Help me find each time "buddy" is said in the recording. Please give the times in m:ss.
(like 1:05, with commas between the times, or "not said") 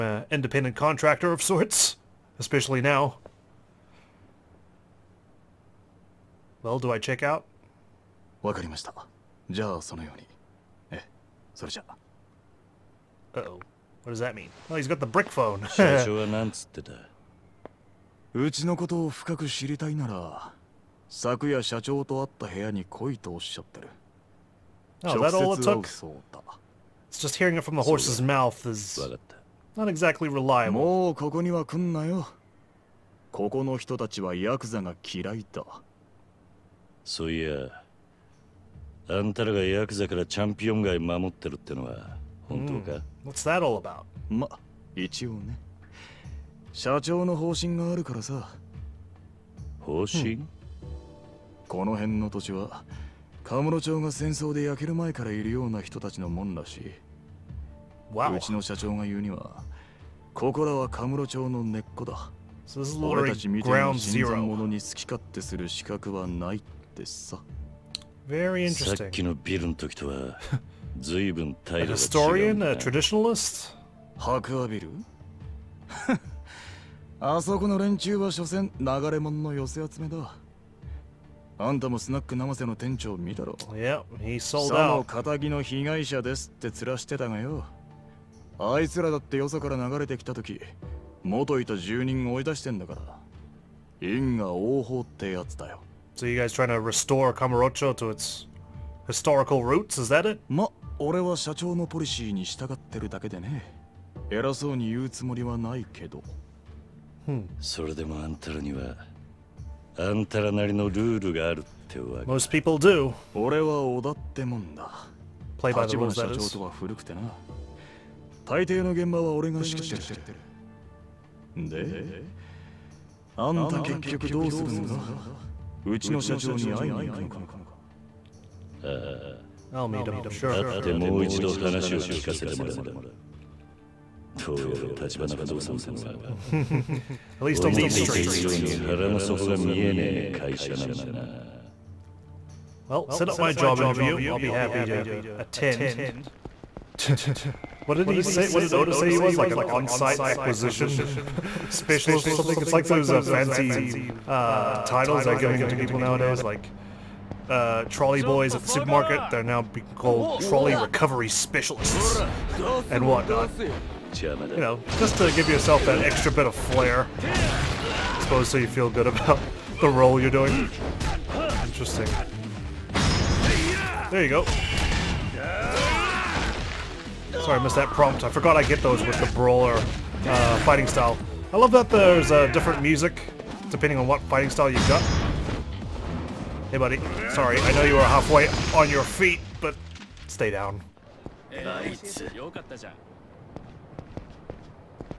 3:06.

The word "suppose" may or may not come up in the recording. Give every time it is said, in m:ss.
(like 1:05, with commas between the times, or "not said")
2:48.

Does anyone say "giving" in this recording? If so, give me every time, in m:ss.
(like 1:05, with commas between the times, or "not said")
2:35.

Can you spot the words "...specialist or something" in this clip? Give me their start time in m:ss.
2:31.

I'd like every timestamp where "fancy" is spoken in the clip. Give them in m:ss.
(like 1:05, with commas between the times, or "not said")
2:33.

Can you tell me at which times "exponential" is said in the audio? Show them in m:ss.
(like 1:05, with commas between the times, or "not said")
not said.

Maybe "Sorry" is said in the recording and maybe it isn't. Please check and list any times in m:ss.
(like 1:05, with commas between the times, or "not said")
2:57, 3:07.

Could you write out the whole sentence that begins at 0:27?
It's just hearing it from the horse's mouth is not exactly reliable.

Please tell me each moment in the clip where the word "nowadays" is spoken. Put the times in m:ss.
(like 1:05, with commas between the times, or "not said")
2:35.